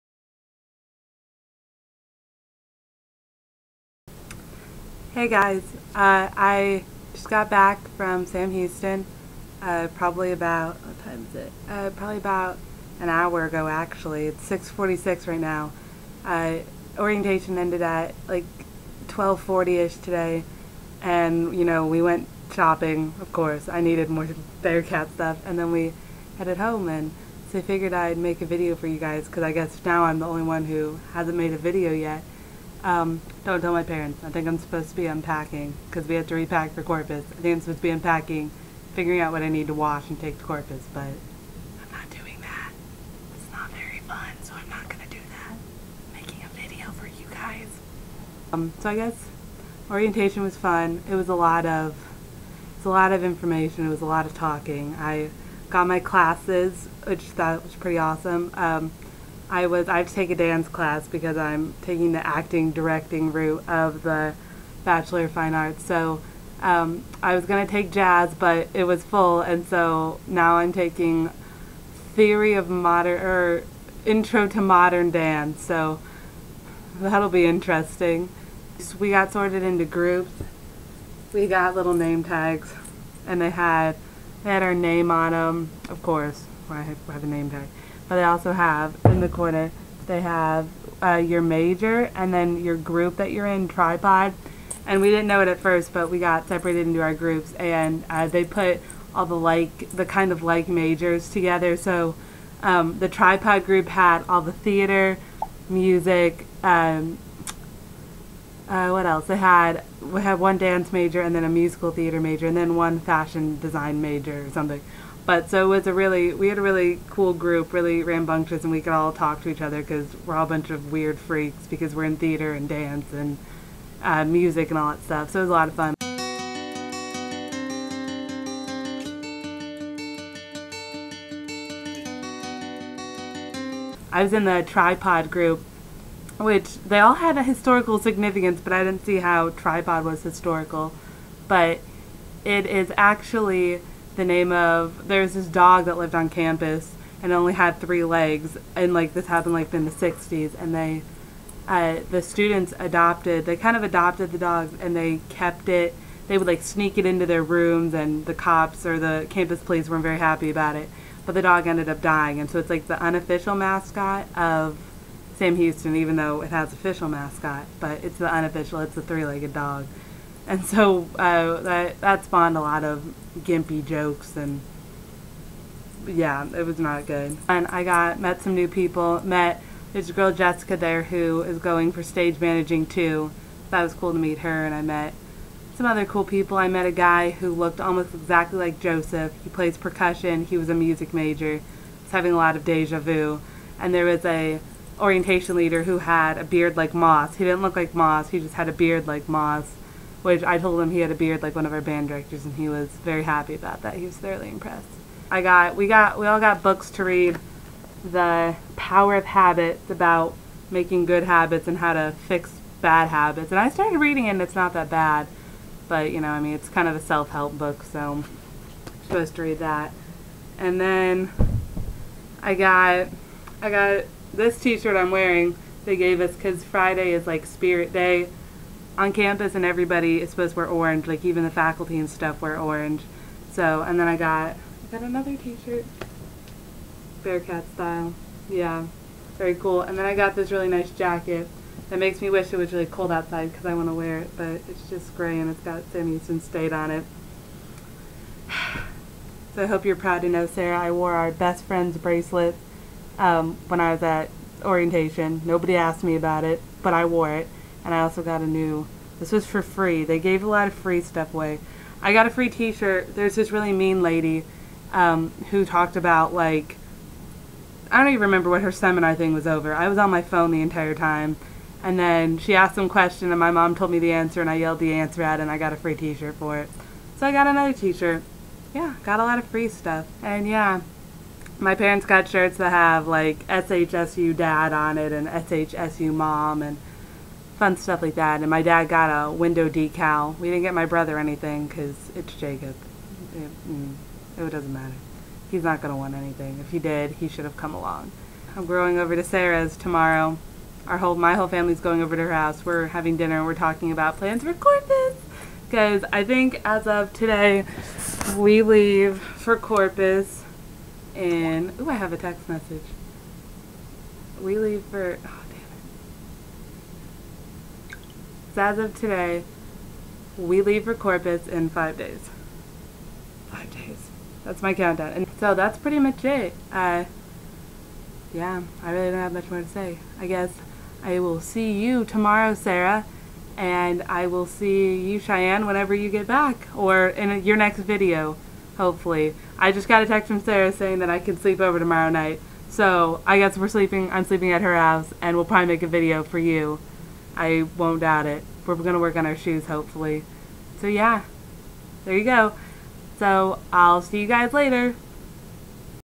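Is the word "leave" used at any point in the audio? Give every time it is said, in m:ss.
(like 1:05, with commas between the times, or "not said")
5:08, 5:14, 5:20.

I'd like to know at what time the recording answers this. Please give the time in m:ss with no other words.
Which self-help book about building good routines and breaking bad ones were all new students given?
3:28.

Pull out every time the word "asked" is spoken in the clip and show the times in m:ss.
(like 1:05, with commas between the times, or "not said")
4:15, 4:32.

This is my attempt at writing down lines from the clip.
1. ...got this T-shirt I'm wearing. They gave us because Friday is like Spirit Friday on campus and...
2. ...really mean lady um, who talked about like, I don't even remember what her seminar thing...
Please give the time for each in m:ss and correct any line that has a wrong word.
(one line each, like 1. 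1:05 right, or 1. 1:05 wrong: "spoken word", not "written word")
1. 3:43 wrong: "Day", not "Friday"
2. 4:23 right.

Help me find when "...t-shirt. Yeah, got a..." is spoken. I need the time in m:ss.
4:37.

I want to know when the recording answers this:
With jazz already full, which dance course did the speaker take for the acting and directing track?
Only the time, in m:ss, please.
1:14.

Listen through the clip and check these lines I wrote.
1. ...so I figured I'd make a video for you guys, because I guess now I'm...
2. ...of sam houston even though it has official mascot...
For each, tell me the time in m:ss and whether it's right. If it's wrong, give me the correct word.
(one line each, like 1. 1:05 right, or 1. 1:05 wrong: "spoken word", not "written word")
1. 0:27 right
2. 2:44 right.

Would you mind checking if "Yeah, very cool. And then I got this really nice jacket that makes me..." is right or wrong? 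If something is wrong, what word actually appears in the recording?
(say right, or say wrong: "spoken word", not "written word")
right.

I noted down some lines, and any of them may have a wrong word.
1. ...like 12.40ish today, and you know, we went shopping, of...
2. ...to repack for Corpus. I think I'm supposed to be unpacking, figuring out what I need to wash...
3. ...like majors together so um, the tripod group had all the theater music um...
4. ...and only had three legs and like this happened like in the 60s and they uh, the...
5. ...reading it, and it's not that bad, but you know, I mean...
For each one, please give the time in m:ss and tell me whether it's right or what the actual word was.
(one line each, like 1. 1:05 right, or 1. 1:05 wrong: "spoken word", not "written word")
1. 0:18 right
2. 0:36 right
3. 1:40 right
4. 2:27 right
5. 3:33 right.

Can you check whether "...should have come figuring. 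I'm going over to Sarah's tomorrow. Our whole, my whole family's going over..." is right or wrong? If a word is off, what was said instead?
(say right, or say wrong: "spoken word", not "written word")
wrong: "along", not "figuring".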